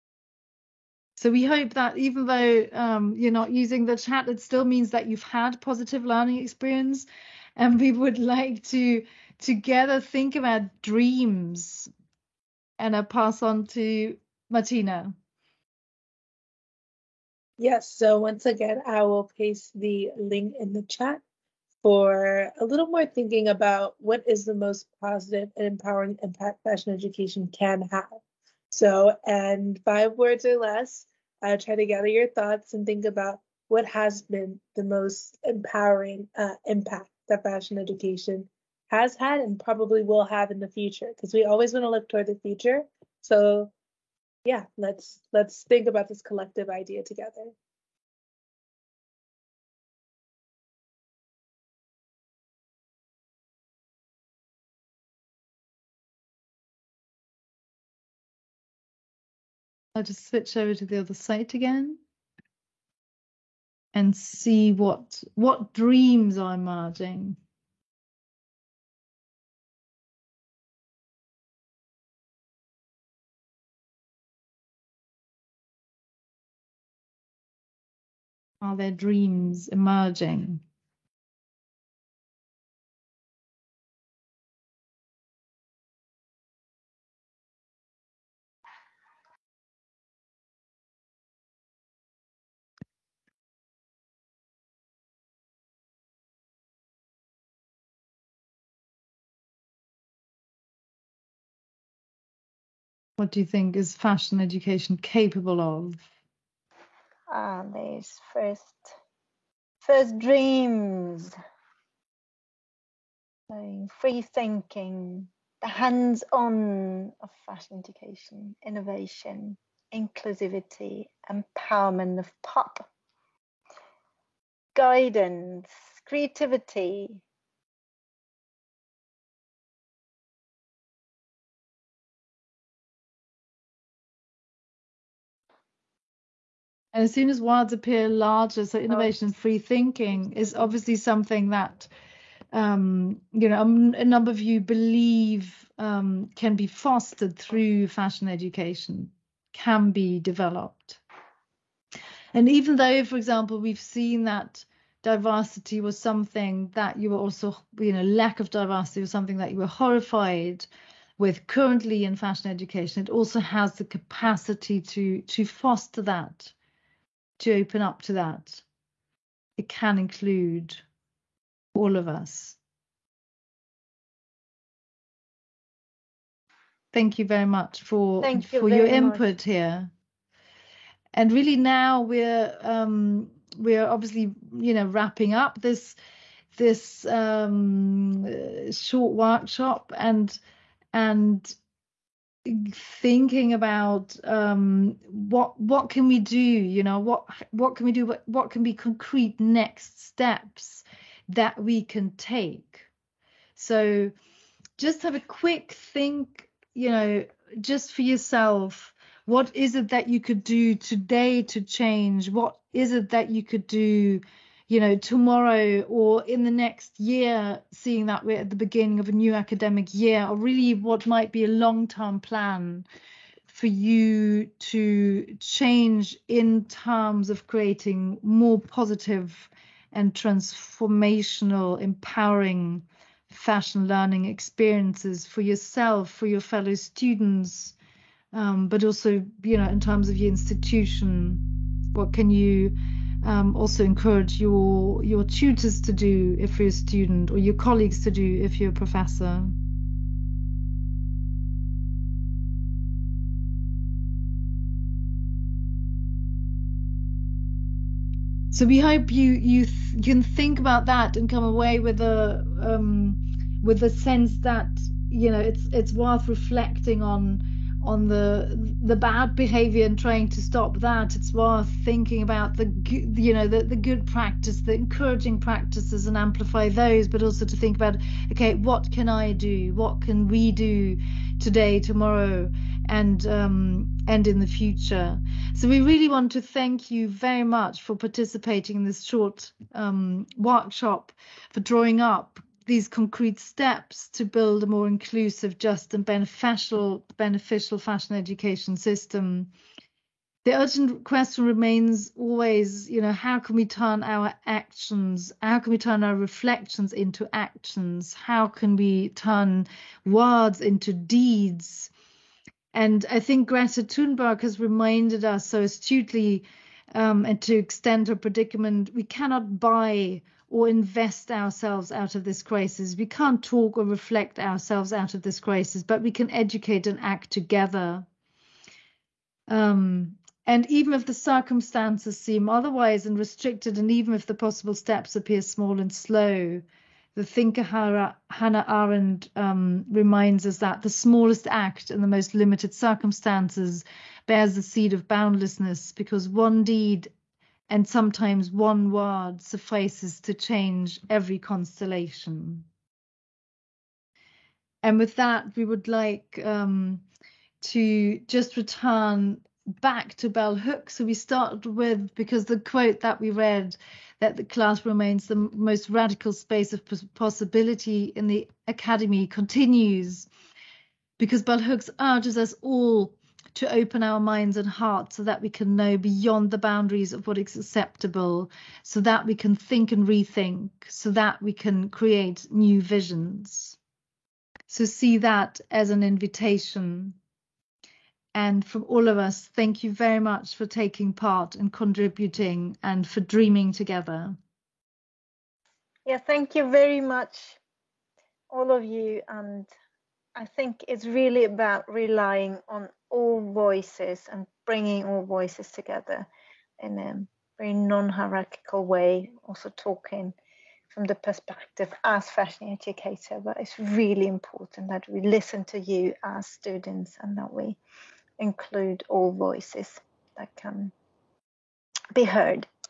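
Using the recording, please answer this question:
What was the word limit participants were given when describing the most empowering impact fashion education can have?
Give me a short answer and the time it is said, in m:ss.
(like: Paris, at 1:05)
5 words or less, at 0:29.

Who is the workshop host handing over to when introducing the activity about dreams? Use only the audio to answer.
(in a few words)
Marteena.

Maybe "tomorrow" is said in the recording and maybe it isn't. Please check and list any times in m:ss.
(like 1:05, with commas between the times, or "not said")
3:34, 4:41.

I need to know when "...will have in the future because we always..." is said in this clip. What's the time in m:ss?
0:40.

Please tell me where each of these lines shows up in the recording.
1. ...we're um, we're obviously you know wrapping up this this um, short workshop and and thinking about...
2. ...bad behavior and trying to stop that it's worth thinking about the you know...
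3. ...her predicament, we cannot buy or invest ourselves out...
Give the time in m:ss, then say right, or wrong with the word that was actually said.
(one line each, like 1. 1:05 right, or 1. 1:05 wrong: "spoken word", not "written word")
1. 3:02 right
2. 4:28 right
3. 5:18 right.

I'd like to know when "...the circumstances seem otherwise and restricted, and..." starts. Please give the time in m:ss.
5:31.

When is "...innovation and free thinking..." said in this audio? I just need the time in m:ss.
2:18.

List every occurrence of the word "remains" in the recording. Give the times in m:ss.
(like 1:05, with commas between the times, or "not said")
5:01, 6:04.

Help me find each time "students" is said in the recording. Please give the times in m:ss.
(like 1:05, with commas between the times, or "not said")
3:56, 4:06, 6:56.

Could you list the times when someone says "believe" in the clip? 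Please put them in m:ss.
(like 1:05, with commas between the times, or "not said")
2:24.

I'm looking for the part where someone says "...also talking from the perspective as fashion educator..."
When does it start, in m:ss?
6:49.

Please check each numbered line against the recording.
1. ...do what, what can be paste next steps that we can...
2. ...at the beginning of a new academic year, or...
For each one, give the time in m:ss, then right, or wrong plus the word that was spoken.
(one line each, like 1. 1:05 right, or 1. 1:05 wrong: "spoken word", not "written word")
1. 3:17 wrong: "concrete", not "paste"
2. 3:38 right.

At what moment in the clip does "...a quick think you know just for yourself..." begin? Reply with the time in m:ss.
3:25.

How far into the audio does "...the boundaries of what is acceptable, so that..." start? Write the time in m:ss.
6:16.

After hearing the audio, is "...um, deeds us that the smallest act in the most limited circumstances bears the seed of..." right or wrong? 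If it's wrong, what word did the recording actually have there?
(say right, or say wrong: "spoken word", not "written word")
wrong: "reminds", not "deeds".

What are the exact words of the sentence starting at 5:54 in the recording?
And with that, we would like um, to just return back to bell Hooks.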